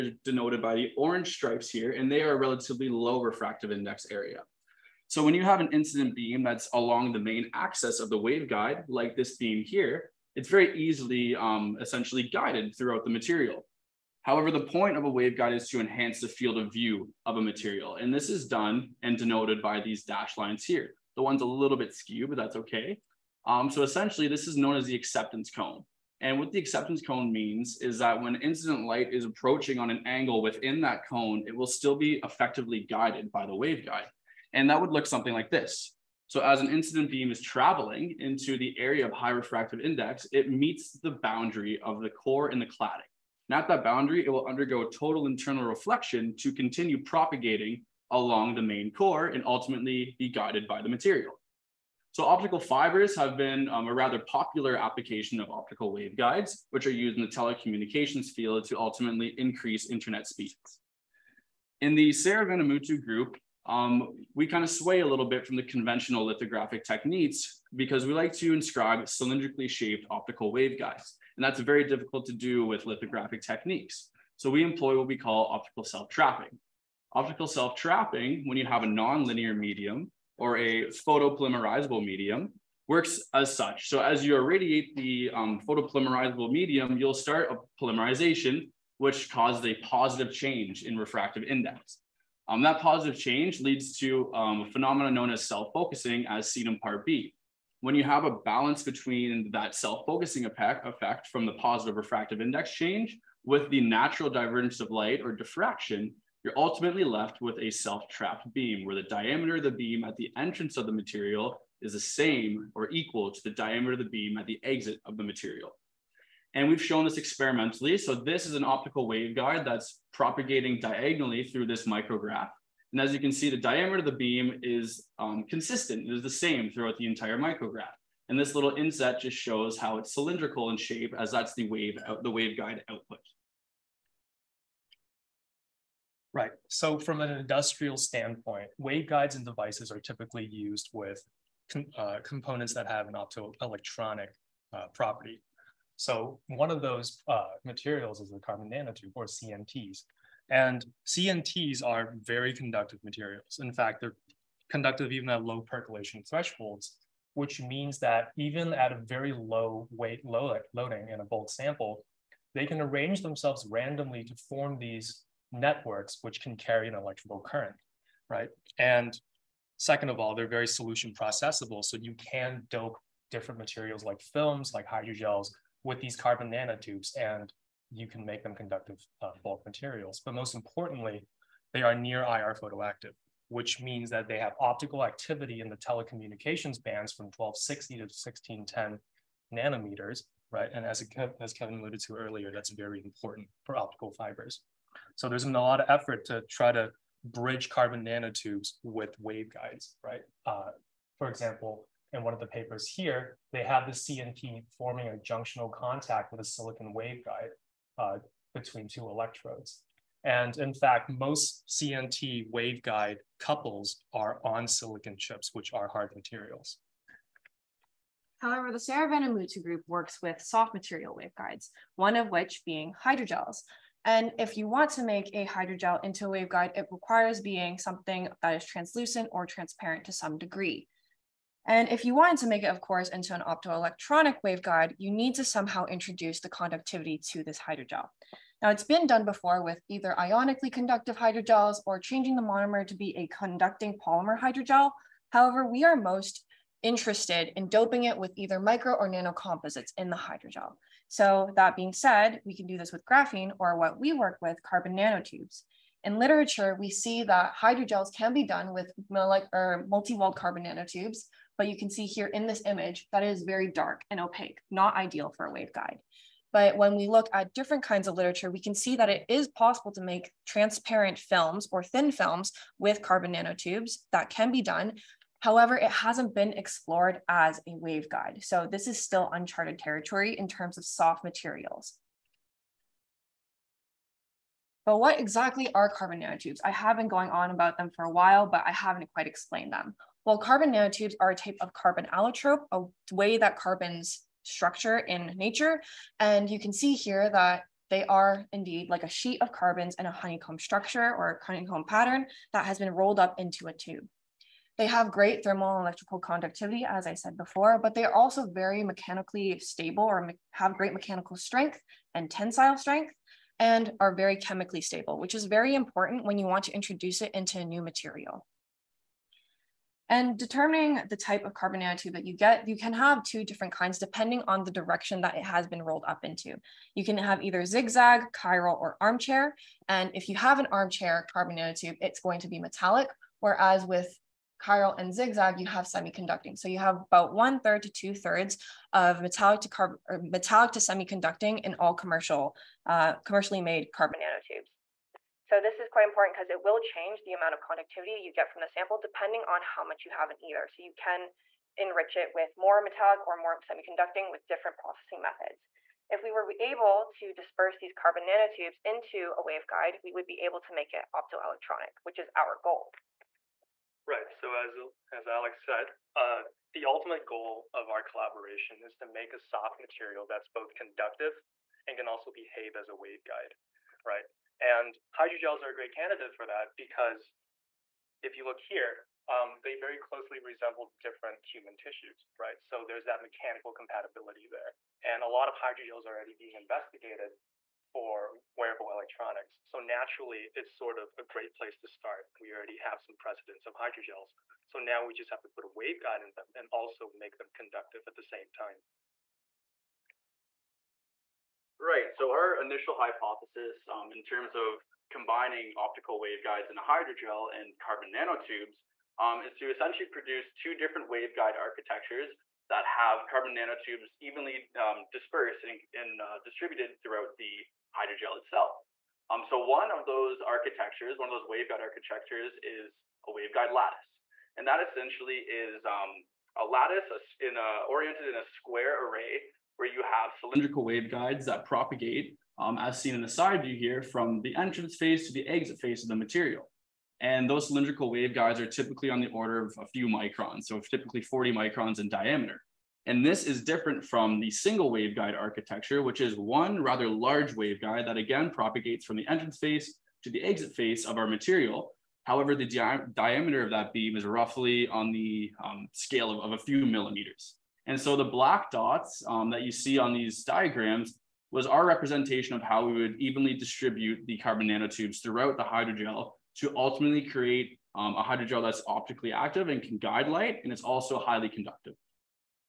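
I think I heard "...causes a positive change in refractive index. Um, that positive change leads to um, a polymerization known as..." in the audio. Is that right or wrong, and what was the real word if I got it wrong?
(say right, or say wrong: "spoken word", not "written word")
wrong: "phenomenon", not "polymerization".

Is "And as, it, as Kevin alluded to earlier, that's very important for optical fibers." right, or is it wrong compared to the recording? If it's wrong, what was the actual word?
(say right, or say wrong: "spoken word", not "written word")
right.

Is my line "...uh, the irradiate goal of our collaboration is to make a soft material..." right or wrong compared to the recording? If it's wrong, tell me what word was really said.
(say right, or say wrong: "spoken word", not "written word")
wrong: "ultimate", not "irradiate".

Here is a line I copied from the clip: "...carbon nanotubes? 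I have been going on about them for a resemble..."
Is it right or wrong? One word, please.
wrong.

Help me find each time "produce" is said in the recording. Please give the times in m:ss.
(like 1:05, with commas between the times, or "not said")
6:50.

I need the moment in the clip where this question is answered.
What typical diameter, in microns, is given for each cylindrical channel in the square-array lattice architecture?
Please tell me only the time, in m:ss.
7:21.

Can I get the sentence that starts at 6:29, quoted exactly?
So naturally, it's sort of a great place to start.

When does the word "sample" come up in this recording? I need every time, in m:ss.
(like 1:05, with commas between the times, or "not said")
2:41, 5:48.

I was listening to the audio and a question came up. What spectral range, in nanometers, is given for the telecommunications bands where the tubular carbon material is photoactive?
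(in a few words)
1260 to 1610 nanometers.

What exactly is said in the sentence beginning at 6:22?
So there's that mechanical compatibility there.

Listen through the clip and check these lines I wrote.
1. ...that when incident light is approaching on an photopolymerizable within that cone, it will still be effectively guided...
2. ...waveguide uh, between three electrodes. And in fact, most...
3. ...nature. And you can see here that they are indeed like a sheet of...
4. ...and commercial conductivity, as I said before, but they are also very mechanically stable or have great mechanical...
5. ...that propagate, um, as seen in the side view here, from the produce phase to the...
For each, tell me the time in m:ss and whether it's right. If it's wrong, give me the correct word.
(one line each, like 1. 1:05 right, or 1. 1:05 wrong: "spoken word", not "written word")
1. 0:27 wrong: "angle", not "photopolymerizable"
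2. 3:26 wrong: "two", not "three"
3. 4:55 right
4. 5:05 wrong: "electrical", not "commercial"
5. 7:11 wrong: "entrance", not "produce".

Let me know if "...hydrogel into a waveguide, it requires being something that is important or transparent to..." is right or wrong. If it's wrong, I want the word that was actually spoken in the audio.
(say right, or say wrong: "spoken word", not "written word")
wrong: "translucent", not "important".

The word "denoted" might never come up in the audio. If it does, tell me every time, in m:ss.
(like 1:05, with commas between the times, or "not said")
0:00, 0:19.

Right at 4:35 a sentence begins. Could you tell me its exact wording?
However, it hasn't been explored as a waveguide.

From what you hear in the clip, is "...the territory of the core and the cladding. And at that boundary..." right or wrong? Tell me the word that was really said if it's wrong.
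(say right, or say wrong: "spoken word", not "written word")
wrong: "boundary", not "territory".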